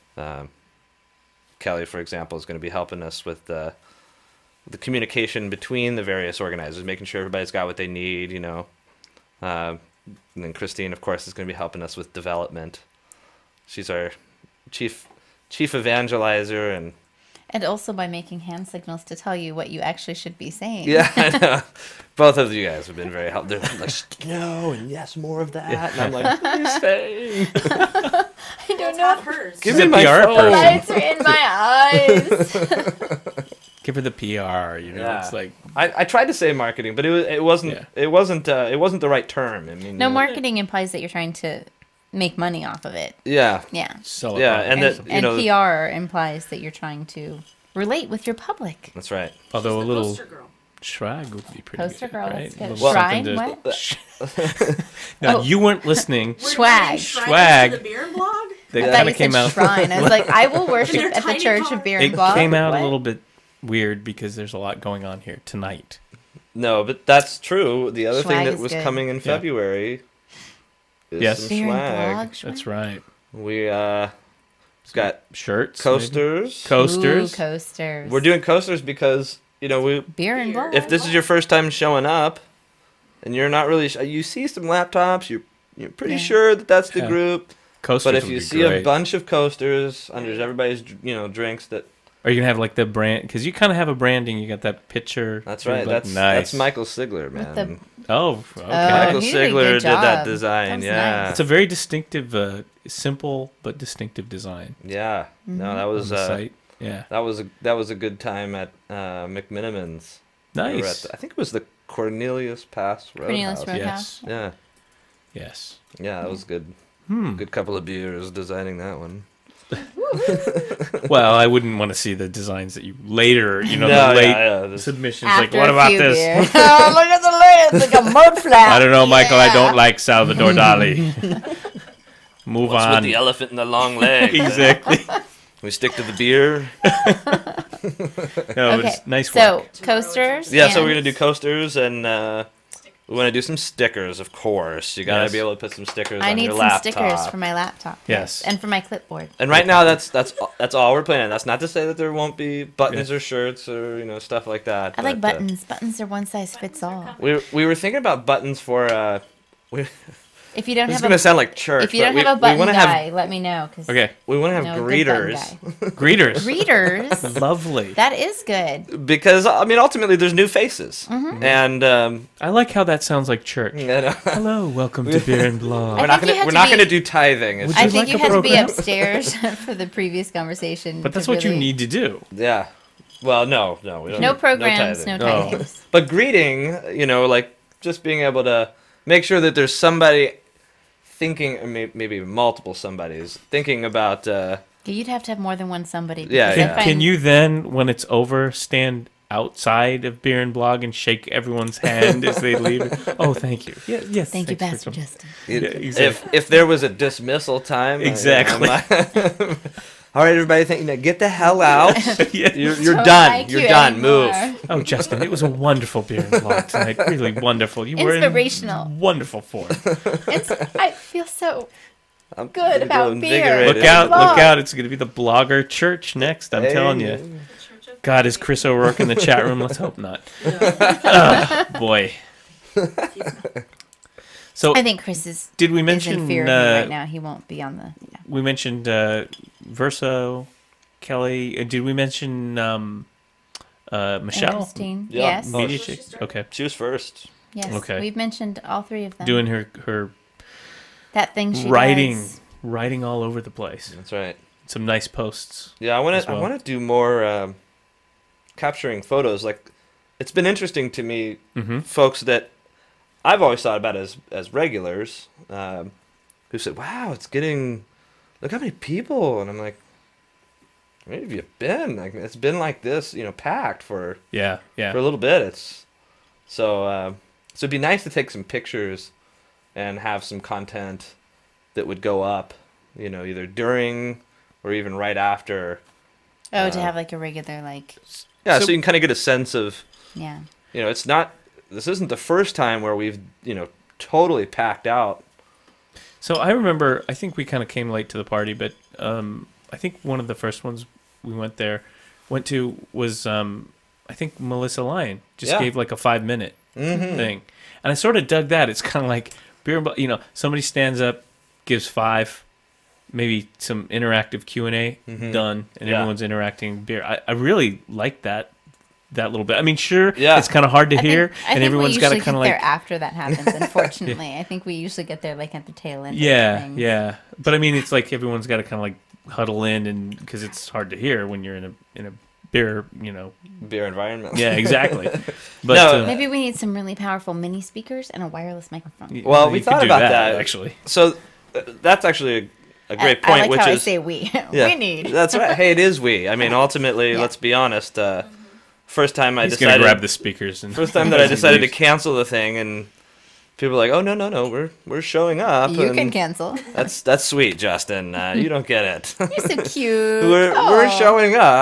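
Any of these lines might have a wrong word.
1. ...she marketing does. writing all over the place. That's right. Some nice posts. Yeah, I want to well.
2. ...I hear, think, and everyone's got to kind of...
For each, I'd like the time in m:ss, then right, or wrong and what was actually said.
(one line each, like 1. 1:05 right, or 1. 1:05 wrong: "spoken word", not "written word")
1. 4:11 wrong: "writing", not "marketing"
2. 5:20 right.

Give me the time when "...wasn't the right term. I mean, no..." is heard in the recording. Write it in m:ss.
0:38.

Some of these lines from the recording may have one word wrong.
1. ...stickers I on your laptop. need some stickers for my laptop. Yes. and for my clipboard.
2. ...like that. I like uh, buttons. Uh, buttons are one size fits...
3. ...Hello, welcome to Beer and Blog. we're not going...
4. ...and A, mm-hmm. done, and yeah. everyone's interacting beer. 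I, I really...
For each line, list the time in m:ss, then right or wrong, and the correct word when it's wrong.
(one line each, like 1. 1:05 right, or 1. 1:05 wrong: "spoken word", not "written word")
1. 2:25 right
2. 2:34 right
3. 2:54 right
4. 5:14 right.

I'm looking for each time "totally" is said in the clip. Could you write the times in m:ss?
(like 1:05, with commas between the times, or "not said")
4:53.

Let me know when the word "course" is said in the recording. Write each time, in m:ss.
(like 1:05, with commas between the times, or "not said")
0:10, 2:24.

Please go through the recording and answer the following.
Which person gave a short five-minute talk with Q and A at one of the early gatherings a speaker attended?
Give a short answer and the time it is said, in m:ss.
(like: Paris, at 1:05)
Melissa Lyon, at 5:04.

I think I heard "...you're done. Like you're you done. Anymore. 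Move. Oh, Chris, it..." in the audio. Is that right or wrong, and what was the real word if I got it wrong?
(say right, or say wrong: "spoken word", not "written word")
wrong: "Justin", not "Chris".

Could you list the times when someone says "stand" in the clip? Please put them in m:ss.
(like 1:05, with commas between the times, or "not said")
3:18, 5:10.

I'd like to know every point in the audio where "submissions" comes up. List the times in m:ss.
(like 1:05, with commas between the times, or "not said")
2:04.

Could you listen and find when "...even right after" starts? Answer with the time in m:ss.
4:44.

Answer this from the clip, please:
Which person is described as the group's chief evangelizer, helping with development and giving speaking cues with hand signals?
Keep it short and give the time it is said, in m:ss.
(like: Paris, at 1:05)
Christine, at 0:10.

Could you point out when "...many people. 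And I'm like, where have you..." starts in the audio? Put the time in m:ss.
4:28.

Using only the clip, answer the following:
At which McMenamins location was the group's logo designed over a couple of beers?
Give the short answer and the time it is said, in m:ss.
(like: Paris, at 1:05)
Cornelius Pass Roadhouse, at 1:51.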